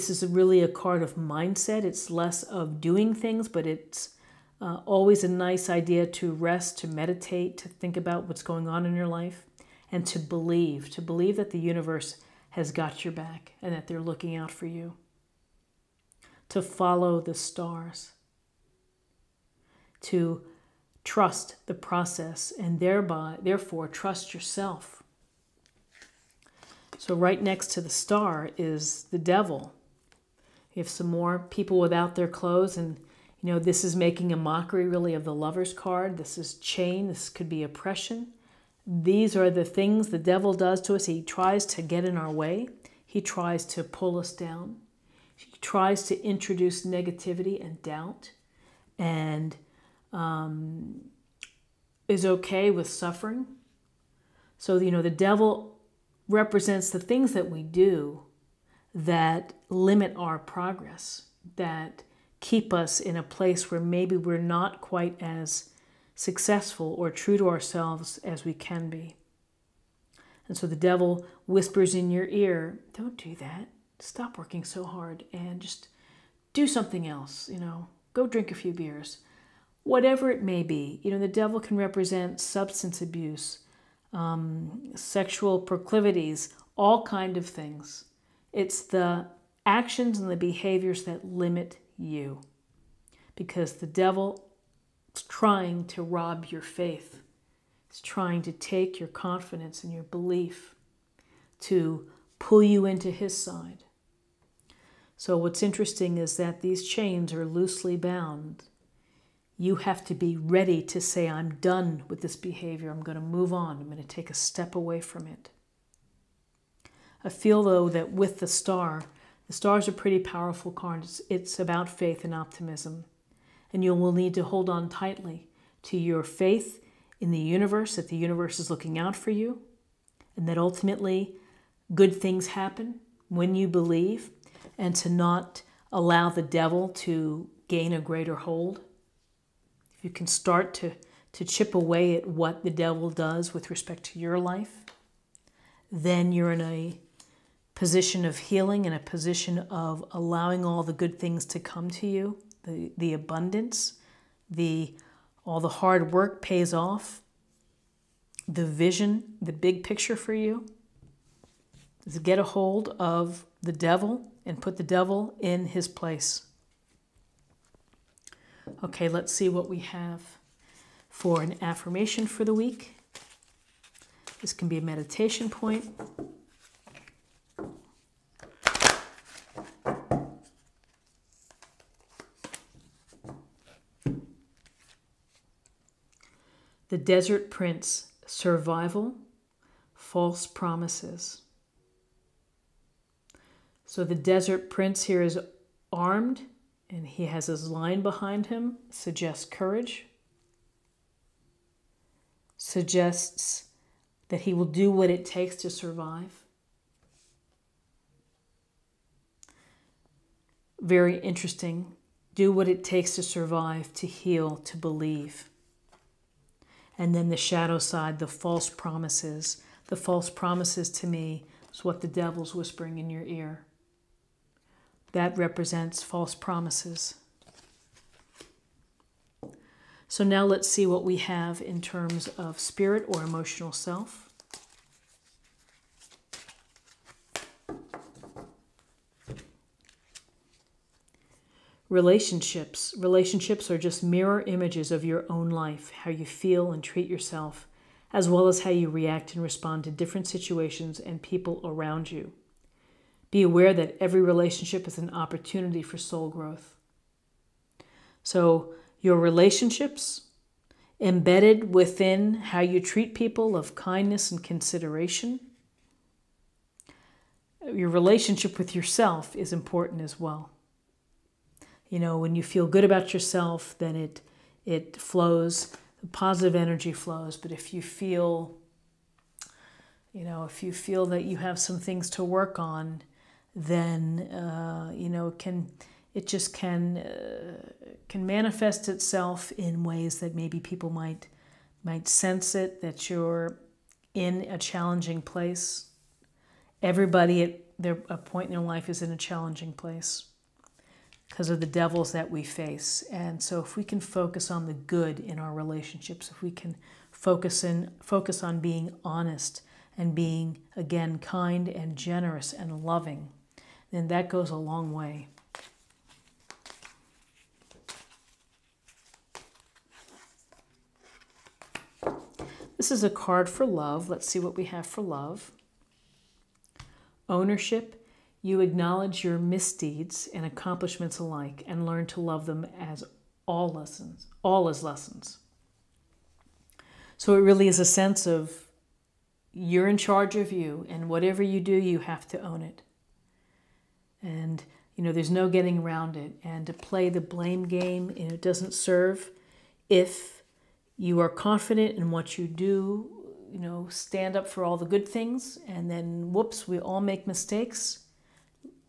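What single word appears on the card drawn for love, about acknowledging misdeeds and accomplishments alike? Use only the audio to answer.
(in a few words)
Ownership.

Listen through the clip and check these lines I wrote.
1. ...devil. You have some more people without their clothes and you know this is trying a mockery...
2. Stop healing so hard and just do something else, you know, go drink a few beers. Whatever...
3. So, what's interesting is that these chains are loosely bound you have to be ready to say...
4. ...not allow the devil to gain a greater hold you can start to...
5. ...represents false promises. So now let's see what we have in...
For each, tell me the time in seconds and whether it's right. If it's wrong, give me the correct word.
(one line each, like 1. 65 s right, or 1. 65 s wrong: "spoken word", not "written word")
1. 29 s wrong: "making", not "trying"
2. 73 s wrong: "working", not "healing"
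3. 105 s right
4. 135 s right
5. 225 s right.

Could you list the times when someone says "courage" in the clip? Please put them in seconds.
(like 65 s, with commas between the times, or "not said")
199 s.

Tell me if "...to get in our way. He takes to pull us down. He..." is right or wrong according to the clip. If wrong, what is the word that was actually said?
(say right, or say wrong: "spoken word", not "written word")
wrong: "tries", not "takes".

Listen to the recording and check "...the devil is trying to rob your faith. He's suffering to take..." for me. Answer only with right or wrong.
wrong.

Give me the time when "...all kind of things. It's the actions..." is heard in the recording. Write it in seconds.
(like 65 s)
86 s.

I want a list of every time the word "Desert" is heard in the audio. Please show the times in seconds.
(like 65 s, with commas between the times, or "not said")
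186 s, 194 s.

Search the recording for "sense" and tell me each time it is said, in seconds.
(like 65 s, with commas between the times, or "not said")
292 s, 337 s.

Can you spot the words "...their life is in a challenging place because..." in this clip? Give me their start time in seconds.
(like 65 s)
298 s.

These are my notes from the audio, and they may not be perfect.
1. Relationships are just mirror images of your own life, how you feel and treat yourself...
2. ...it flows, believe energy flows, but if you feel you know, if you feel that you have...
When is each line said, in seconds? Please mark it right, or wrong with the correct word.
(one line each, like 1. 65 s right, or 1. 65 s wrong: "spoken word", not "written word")
1. 242 s right
2. 274 s wrong: "positive", not "believe".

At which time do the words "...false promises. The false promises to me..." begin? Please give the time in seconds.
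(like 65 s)
218 s.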